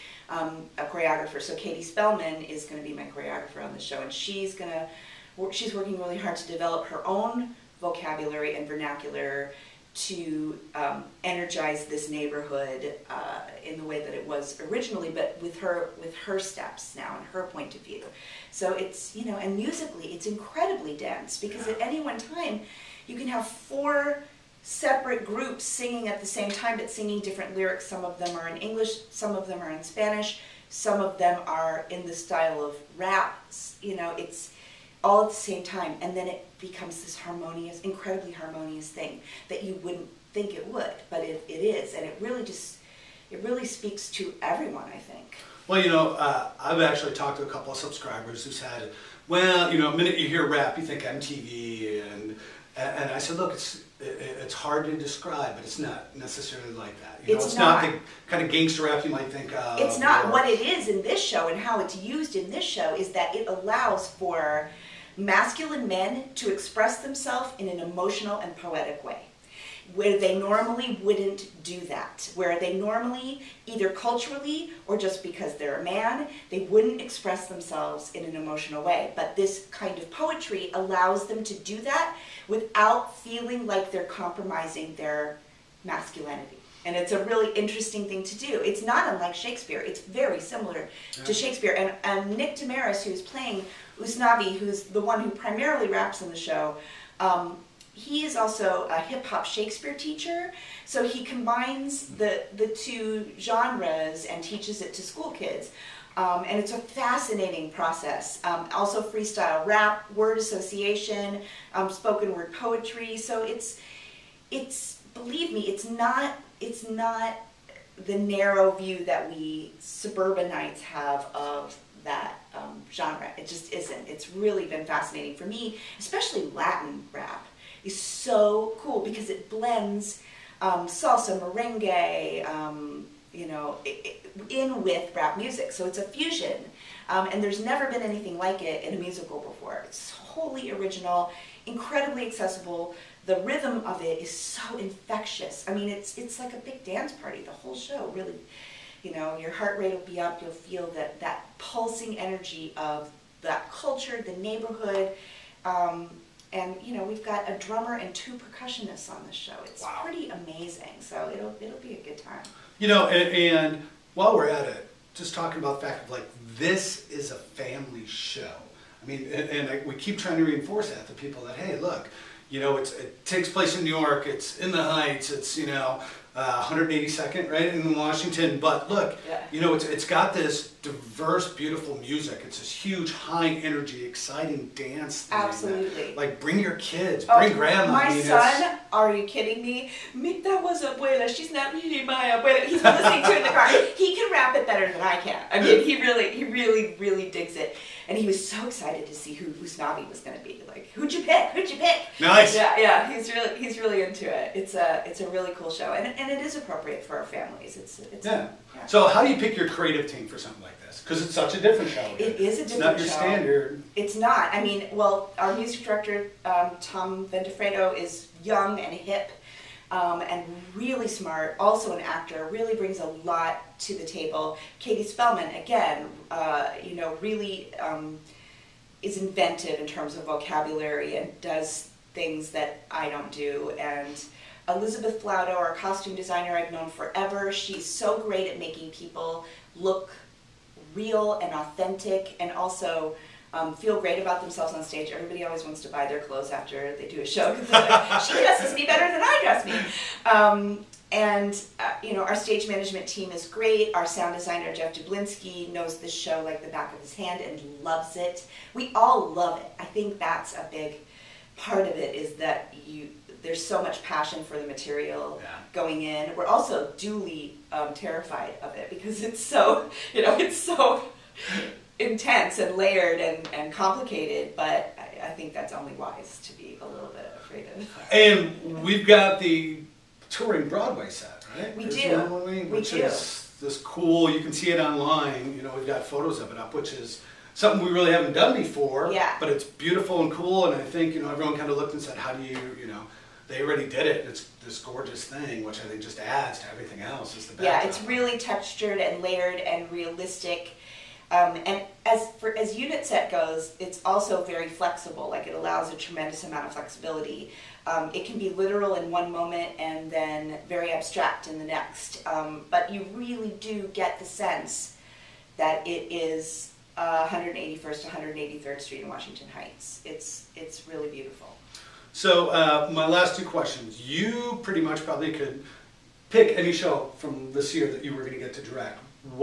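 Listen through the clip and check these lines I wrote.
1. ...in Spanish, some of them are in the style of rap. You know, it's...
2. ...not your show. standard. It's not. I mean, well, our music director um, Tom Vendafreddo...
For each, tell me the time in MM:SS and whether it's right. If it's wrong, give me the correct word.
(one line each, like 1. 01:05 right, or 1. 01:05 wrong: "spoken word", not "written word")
1. 00:29 right
2. 03:32 right.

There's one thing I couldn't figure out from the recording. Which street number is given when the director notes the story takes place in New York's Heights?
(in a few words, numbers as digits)
182nd.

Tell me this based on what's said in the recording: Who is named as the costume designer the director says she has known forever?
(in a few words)
Elizabeth Flauto.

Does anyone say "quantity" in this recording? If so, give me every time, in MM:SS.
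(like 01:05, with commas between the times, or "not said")
not said.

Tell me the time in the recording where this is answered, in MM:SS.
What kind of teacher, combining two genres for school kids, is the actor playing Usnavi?
01:38.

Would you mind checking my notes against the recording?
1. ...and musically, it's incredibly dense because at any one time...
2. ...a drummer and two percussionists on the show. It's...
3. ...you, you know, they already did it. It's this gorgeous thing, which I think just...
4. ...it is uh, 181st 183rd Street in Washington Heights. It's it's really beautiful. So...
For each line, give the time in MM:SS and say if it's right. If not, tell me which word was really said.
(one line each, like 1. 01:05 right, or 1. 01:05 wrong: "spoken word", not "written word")
1. 00:19 right
2. 02:37 right
3. 04:52 right
4. 05:15 right.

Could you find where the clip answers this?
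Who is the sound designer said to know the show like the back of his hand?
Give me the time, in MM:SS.
04:14.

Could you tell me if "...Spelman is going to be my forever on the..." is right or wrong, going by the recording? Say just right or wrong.
wrong.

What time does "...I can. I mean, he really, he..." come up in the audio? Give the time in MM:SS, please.
03:15.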